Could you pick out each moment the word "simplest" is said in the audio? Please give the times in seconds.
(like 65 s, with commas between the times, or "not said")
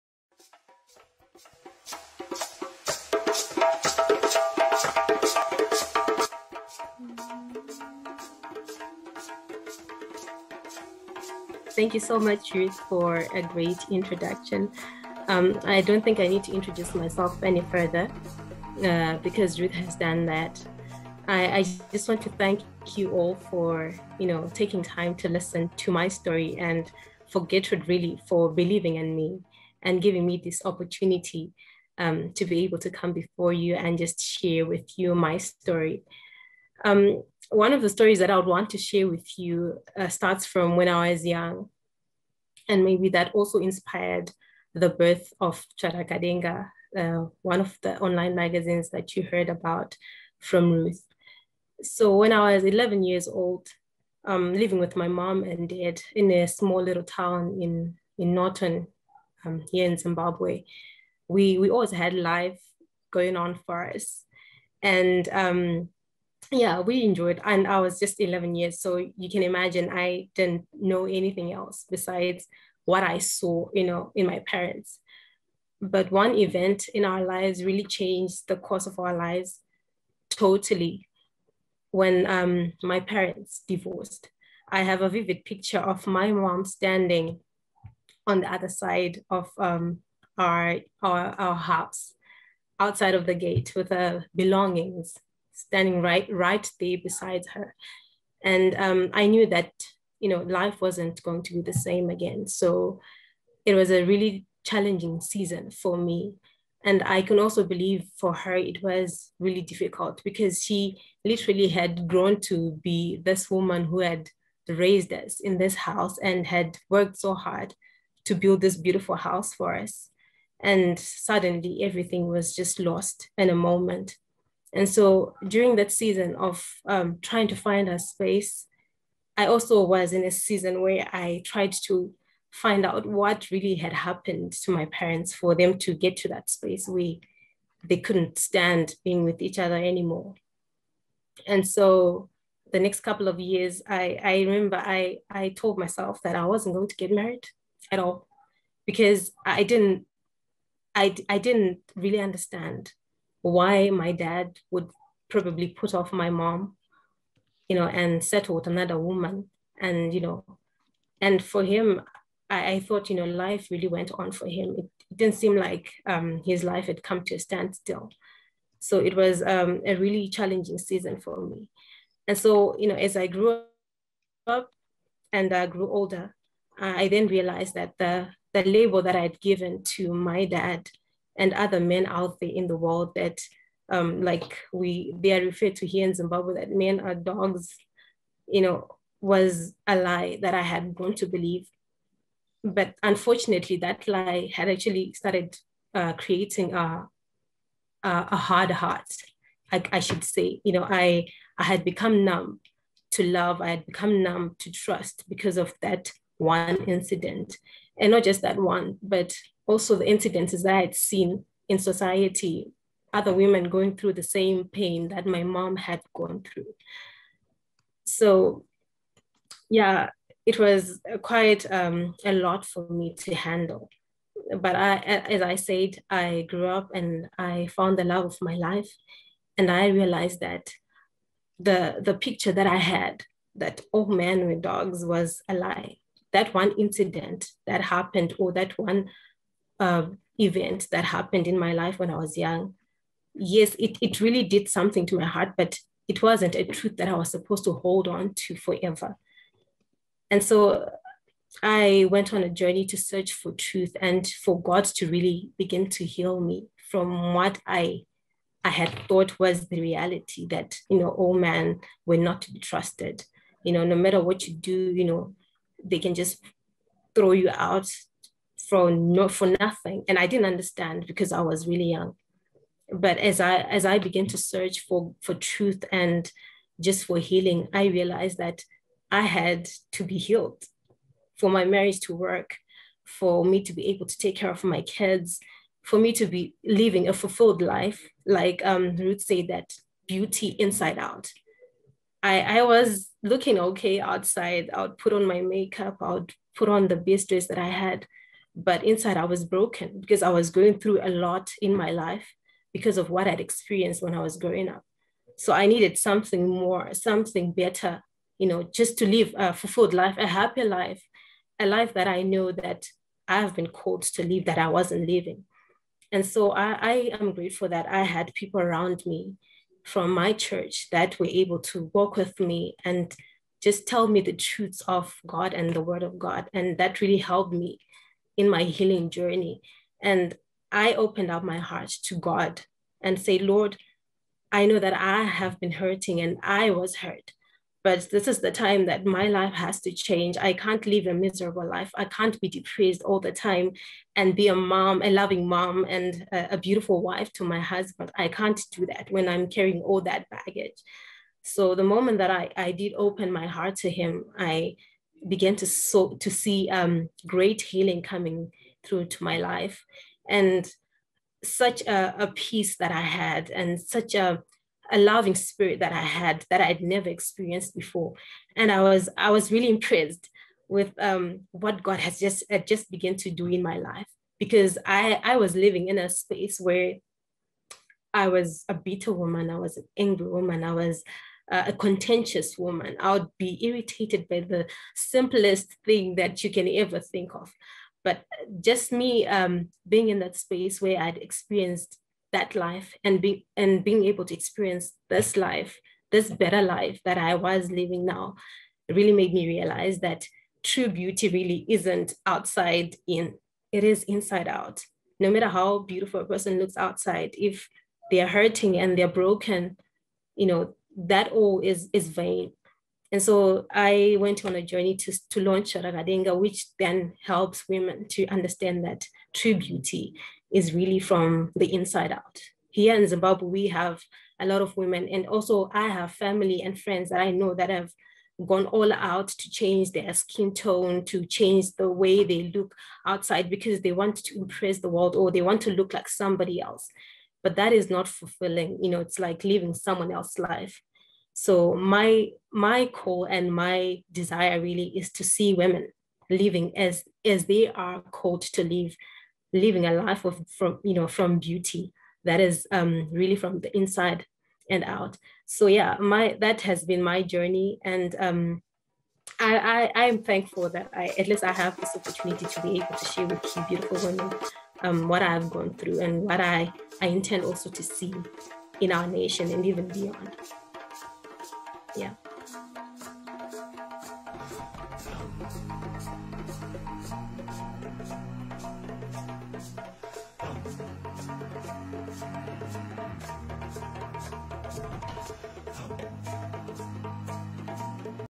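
384 s.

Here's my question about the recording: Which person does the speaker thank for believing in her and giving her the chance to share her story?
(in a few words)
Gertrude.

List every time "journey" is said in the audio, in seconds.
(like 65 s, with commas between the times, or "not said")
252 s, 329 s, 414 s, 457 s.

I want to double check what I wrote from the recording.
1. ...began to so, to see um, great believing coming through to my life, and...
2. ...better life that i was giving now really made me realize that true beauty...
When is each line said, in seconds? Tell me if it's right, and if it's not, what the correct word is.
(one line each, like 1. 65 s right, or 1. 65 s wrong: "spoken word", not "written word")
1. 355 s wrong: "healing", not "believing"
2. 396 s wrong: "living", not "giving".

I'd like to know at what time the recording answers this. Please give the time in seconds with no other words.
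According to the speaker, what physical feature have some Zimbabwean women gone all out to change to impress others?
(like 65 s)
430 s.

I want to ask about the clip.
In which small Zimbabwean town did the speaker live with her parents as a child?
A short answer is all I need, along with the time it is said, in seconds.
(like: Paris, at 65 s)
Norton, at 58 s.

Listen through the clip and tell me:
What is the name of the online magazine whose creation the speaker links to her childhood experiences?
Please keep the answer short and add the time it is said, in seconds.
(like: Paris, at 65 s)
Charakadenga, at 45 s.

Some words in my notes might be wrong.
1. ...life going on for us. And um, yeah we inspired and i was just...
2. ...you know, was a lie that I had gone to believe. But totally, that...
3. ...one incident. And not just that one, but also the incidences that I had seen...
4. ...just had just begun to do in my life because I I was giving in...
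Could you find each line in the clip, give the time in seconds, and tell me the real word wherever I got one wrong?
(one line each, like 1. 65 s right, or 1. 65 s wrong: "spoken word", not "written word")
1. 62 s wrong: "enjoyed", not "inspired"
2. 188 s wrong: "unfortunately", not "totally"
3. 206 s right
4. 372 s wrong: "living", not "giving".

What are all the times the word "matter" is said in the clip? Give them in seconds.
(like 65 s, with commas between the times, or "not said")
263 s, 405 s.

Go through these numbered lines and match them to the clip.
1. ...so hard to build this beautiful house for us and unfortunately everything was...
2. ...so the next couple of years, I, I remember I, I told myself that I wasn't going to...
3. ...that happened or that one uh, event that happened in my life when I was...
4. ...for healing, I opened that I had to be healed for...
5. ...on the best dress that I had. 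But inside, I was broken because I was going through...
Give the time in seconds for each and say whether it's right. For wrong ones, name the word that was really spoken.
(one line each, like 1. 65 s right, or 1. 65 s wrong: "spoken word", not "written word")
1. 117 s wrong: "suddenly", not "unfortunately"
2. 141 s right
3. 237 s right
4. 277 s wrong: "realized", not "opened"
5. 296 s right.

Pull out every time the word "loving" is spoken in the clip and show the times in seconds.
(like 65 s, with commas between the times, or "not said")
345 s, 364 s.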